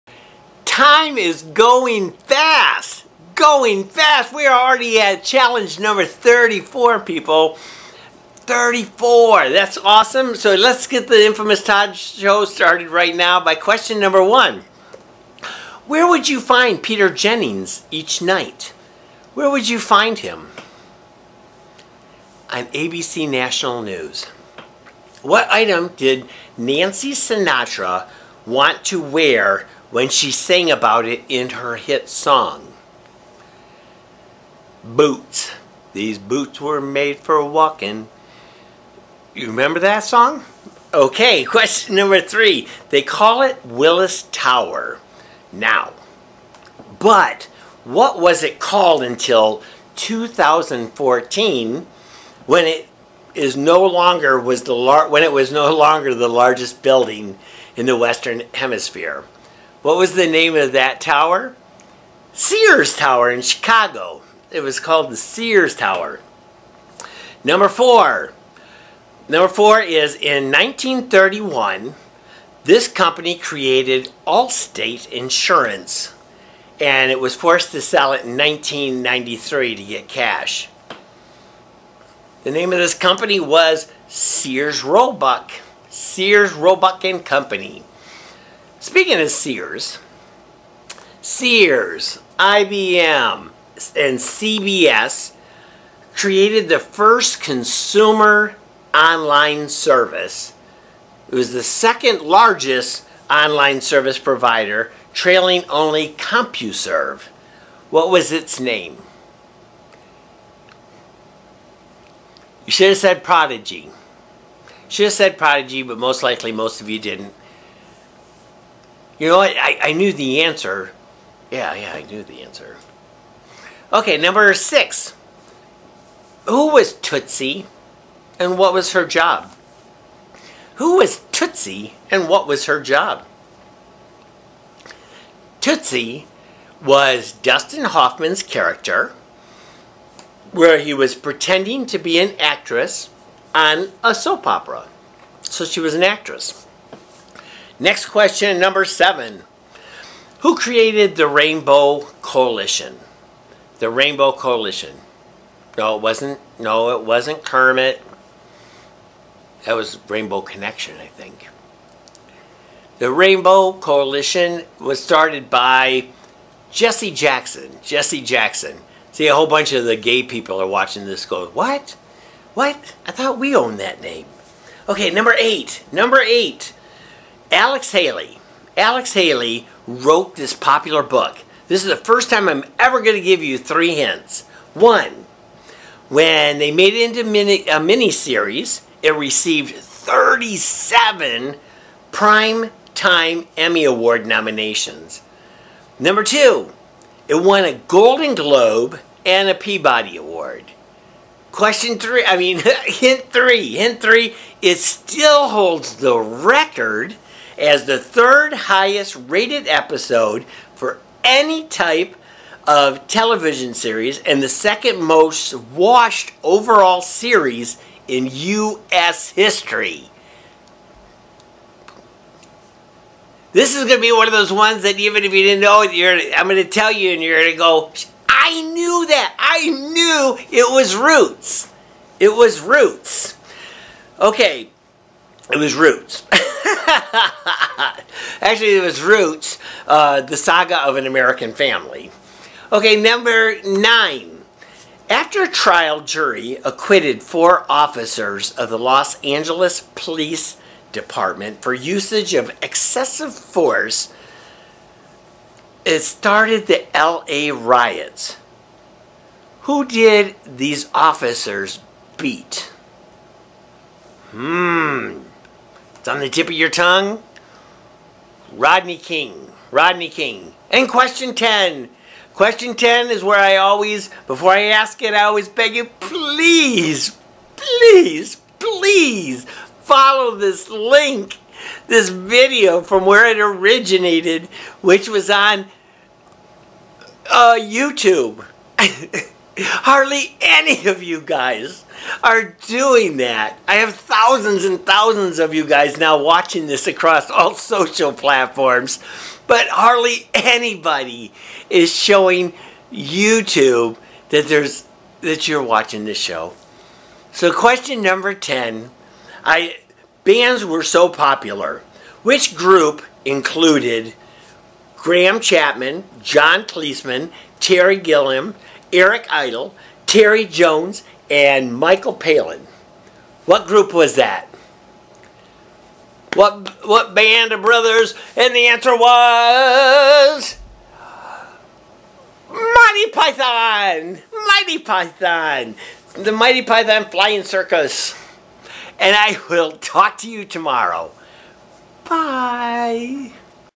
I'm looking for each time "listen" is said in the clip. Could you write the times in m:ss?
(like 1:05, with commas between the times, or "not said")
not said.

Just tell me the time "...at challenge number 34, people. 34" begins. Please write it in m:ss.
0:05.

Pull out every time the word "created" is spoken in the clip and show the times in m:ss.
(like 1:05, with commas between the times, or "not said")
1:13, 1:36, 2:30.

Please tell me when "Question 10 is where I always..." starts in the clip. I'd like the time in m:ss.
4:32.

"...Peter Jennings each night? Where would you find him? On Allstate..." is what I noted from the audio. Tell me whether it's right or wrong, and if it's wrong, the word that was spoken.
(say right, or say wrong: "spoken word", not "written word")
wrong: "ABC", not "Allstate".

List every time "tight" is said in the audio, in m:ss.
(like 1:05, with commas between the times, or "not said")
not said.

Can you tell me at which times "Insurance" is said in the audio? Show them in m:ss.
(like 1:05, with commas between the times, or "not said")
1:15.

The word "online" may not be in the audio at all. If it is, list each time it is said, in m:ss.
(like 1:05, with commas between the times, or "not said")
1:38, 1:43.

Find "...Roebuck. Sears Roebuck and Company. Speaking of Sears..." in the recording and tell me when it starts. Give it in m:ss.
1:24.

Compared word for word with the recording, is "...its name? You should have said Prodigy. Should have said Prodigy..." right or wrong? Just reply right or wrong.
right.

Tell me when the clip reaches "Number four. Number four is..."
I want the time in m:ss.
1:07.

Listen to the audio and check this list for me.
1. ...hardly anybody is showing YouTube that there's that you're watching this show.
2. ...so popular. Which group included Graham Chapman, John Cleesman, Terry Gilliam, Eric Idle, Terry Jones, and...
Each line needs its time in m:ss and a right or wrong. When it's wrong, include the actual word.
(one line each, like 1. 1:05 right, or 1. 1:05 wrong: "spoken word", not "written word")
1. 4:59 right
2. 5:10 right.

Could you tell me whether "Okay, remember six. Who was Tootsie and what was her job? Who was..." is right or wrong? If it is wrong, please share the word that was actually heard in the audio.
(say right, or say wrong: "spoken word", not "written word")
wrong: "number", not "remember".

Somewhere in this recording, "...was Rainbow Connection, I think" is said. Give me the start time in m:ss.
2:39.